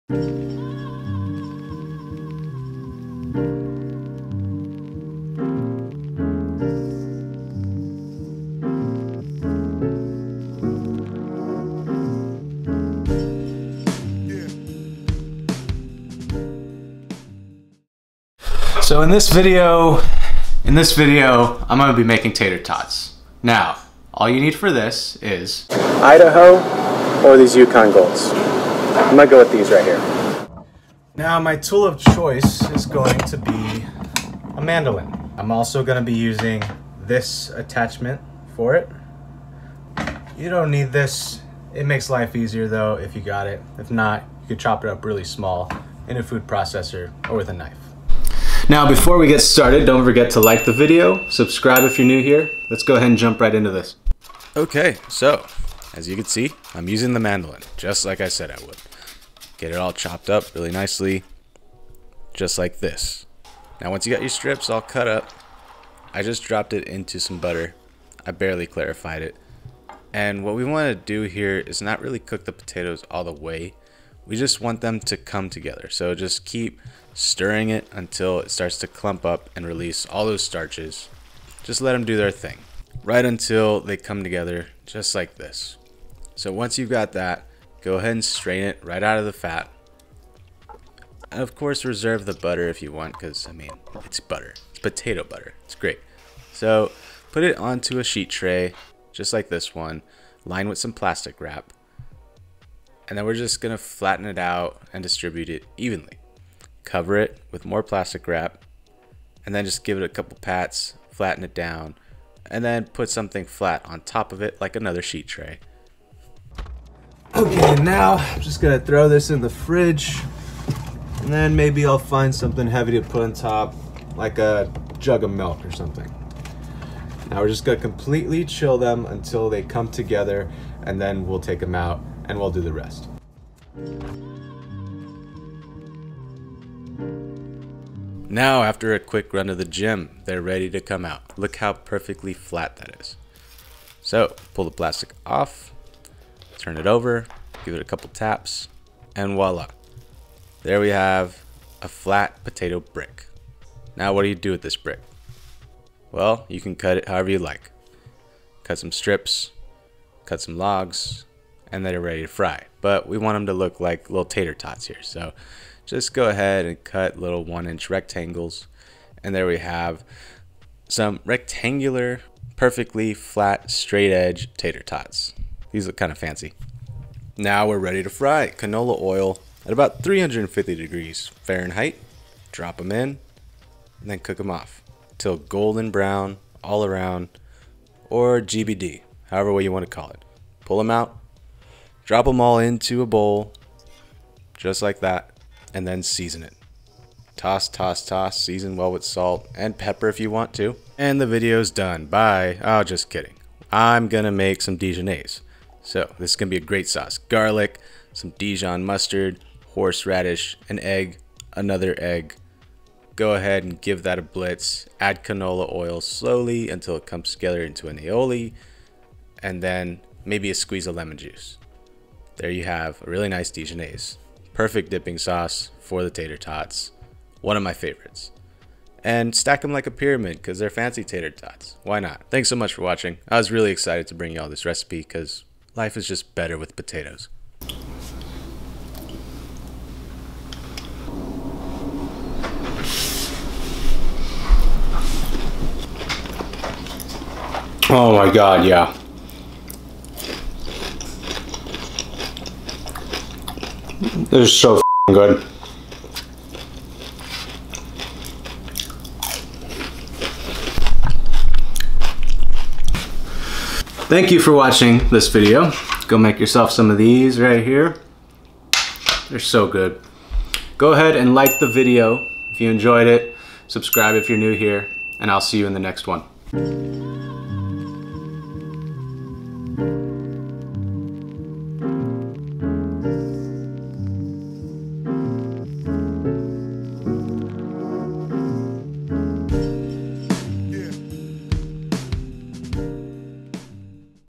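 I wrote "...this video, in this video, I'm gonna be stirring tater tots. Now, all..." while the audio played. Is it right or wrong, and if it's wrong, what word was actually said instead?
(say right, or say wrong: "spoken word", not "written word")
wrong: "making", not "stirring".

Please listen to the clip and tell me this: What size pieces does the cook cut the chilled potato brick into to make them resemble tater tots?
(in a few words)
1 inch rectangles.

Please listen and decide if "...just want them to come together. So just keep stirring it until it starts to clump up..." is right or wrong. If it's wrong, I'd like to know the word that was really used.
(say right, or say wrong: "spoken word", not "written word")
right.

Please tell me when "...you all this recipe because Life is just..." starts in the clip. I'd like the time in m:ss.
3:54.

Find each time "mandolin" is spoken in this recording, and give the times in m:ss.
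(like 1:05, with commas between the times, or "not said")
0:34, 0:57.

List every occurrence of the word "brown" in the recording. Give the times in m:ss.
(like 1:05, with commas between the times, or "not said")
3:05.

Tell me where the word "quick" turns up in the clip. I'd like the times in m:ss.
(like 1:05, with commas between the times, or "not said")
2:18.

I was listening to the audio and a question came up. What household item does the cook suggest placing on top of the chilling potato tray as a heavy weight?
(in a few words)
A jug of milk.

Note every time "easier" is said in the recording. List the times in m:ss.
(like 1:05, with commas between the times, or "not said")
0:42.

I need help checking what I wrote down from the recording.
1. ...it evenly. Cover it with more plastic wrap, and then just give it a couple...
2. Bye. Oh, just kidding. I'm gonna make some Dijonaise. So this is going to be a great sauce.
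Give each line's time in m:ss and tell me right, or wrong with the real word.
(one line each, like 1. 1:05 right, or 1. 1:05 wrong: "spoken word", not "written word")
1. 1:45 right
2. 3:22 right.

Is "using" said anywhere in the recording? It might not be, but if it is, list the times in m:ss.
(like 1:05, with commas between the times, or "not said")
0:36, 0:56.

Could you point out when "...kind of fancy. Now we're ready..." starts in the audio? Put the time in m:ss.
2:55.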